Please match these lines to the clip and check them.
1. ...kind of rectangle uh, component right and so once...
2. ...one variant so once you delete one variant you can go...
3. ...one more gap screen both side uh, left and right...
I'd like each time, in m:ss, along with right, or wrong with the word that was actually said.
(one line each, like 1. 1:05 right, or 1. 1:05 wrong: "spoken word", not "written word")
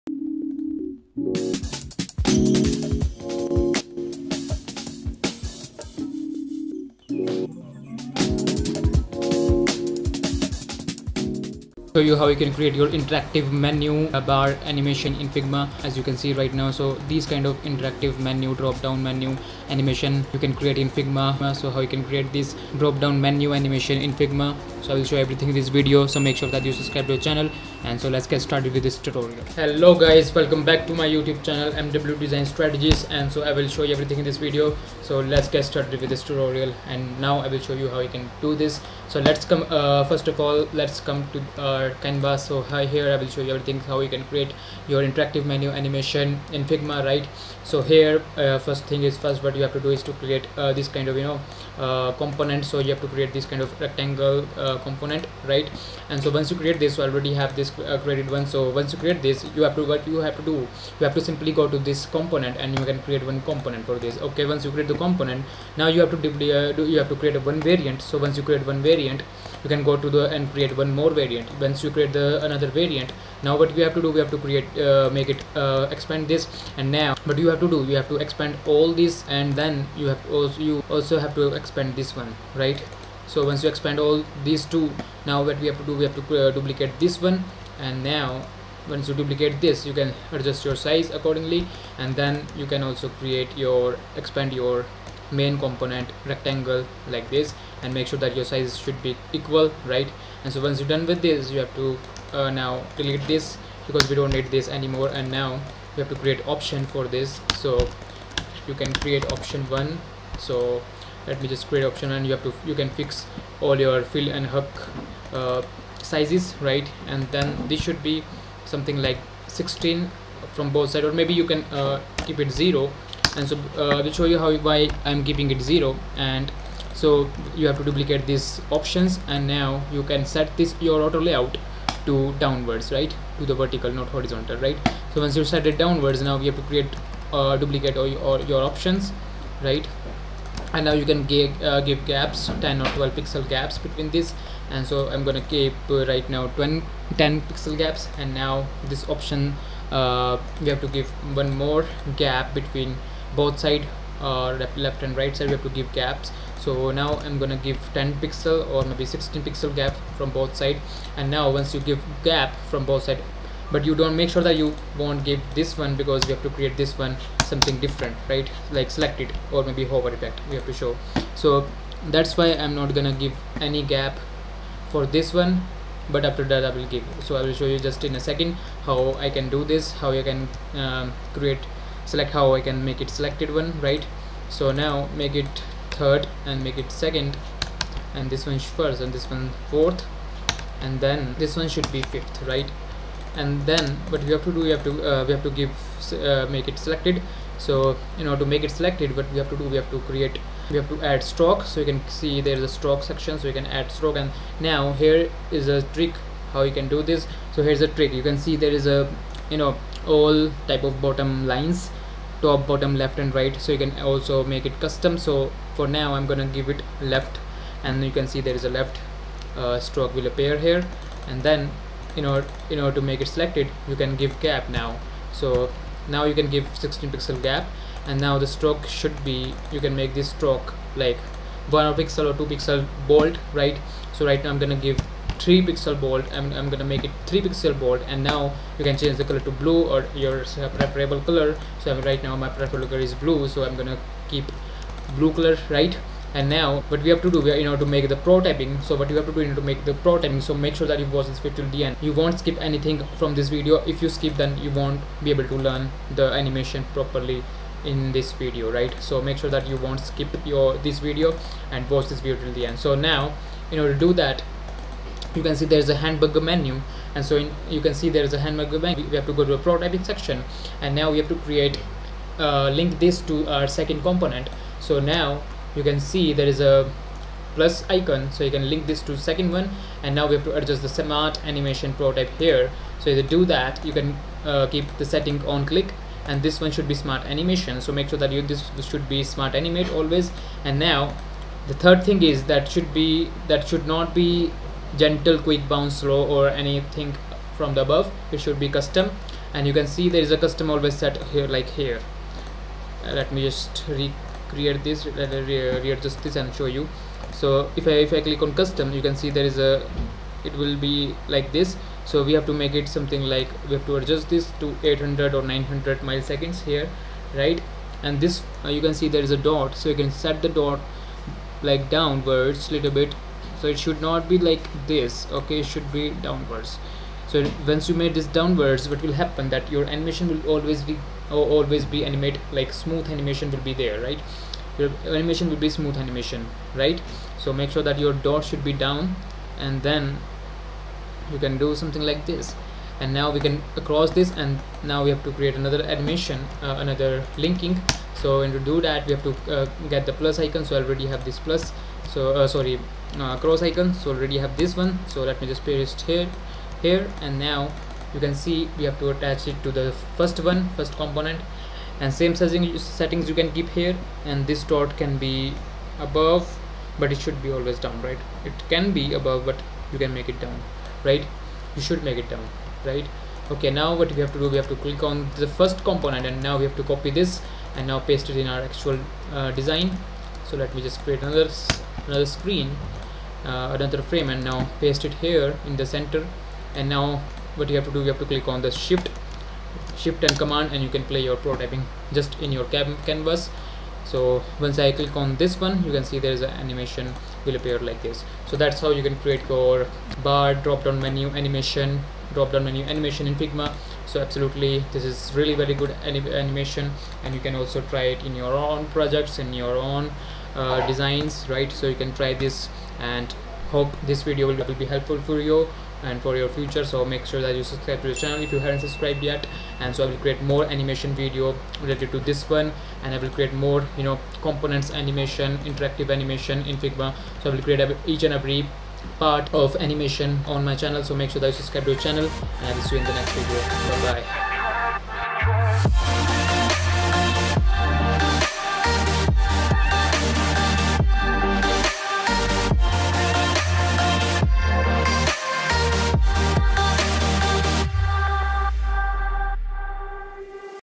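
1. 0:53 right
2. 1:07 wrong: "create", not "delete"
3. 2:31 wrong: "between", not "screen".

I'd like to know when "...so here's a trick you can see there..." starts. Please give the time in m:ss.
3:27.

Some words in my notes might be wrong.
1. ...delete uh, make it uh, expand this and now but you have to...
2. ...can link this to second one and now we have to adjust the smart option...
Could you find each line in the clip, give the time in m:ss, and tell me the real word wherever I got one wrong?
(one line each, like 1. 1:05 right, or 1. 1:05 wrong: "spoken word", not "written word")
1. 1:14 wrong: "create", not "delete"
2. 4:38 wrong: "animation", not "option".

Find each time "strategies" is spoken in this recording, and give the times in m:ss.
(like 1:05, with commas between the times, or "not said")
0:32.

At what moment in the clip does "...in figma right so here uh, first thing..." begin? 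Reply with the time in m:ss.
0:46.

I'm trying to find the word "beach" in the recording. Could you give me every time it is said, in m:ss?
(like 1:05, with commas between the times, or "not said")
not said.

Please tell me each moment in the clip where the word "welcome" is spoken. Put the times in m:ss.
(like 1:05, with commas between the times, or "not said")
0:30.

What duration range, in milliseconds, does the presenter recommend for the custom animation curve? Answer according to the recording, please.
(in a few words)
800 or 900.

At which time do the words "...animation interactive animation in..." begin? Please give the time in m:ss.
7:04.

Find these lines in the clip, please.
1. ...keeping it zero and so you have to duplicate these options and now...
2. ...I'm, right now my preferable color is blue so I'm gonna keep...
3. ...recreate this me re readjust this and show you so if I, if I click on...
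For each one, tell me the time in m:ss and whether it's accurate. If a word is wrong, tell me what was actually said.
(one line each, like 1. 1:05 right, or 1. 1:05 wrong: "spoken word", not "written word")
1. 2:05 right
2. 4:01 right
3. 5:03 right.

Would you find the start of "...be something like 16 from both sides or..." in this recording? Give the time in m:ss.
1:58.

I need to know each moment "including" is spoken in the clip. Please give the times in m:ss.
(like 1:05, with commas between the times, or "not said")
not said.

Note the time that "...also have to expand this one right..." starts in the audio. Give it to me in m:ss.
1:20.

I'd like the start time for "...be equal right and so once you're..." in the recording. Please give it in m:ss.
1:39.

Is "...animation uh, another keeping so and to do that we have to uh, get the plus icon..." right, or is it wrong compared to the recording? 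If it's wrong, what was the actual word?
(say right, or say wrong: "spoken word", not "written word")
wrong: "linking", not "keeping".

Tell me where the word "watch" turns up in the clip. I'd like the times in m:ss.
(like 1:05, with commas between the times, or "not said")
4:11, 4:21.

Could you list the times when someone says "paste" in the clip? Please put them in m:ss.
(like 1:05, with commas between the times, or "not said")
5:55, 6:17, 6:24.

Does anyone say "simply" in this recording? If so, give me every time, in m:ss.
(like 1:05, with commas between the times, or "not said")
1:01.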